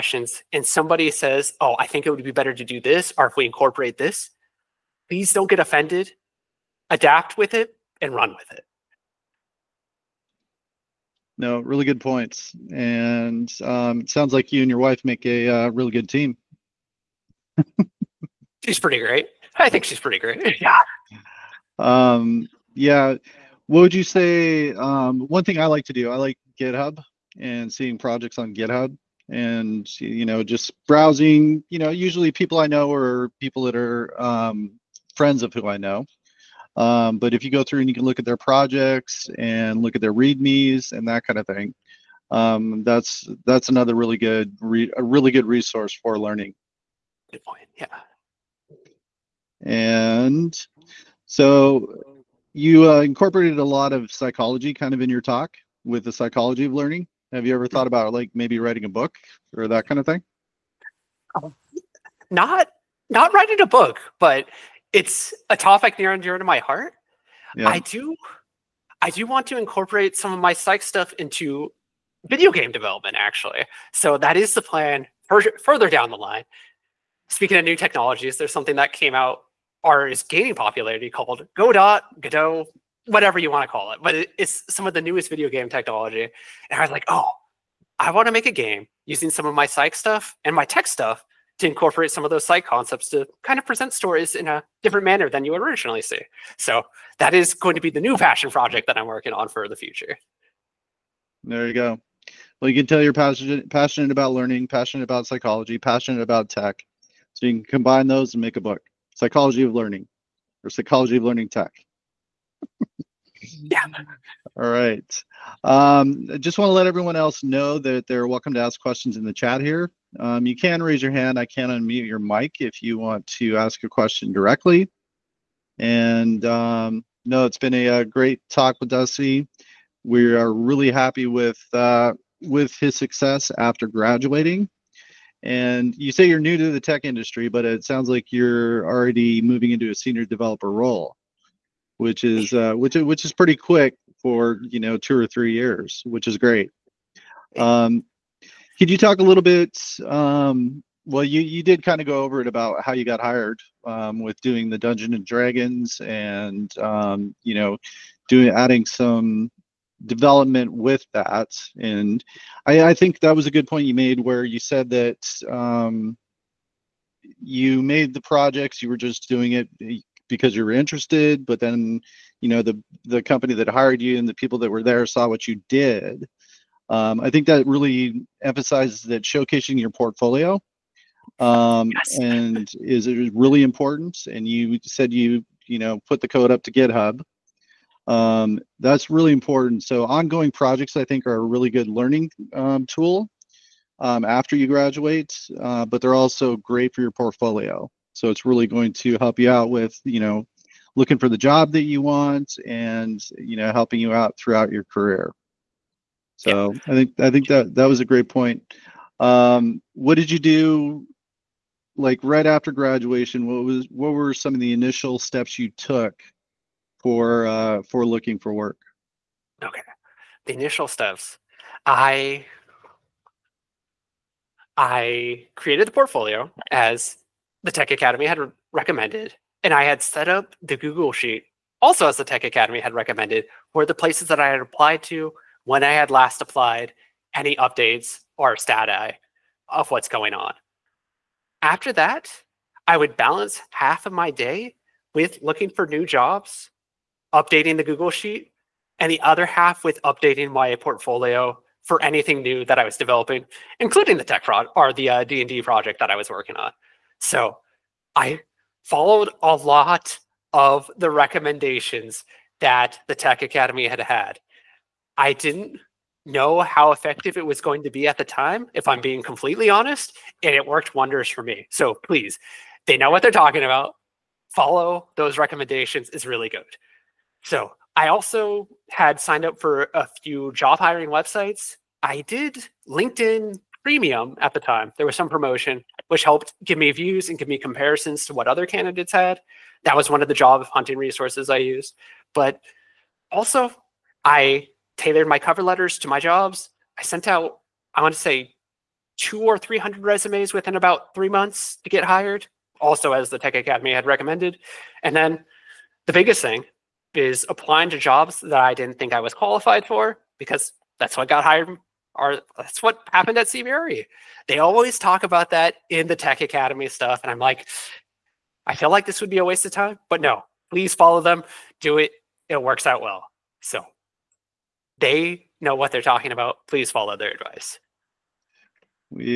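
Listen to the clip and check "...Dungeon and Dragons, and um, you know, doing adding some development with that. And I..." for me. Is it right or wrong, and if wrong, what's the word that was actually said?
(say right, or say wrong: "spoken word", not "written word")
right.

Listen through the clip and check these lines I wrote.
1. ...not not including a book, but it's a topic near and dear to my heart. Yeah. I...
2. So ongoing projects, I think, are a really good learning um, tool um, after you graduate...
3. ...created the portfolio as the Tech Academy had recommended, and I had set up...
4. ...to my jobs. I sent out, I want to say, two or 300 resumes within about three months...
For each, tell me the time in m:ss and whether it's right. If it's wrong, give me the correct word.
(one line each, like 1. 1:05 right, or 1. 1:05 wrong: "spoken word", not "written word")
1. 1:02 wrong: "writing", not "including"
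2. 3:09 right
3. 3:45 right
4. 4:55 right.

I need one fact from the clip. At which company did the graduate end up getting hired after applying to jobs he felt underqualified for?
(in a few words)
CBRE.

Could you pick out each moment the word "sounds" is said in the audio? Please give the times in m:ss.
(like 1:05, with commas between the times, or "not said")
0:14, 2:17.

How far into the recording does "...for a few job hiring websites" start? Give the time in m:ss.
4:39.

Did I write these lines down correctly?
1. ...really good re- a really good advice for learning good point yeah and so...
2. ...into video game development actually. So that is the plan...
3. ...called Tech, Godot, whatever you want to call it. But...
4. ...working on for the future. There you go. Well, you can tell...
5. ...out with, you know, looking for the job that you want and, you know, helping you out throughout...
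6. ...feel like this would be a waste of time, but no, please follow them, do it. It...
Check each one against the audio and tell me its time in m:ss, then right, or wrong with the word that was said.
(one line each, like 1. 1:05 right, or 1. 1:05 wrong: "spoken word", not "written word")
1. 0:43 wrong: "resource", not "advice"
2. 1:11 right
3. 1:21 wrong: "Godot", not "Tech"
4. 1:39 right
5. 3:19 right
6. 5:18 right.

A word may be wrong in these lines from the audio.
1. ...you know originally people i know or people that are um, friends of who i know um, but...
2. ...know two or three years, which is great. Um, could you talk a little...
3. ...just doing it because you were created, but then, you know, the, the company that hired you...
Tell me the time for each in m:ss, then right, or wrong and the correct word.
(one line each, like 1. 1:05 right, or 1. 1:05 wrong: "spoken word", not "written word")
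1. 0:31 wrong: "usually", not "originally"
2. 2:24 right
3. 2:48 wrong: "interested", not "created".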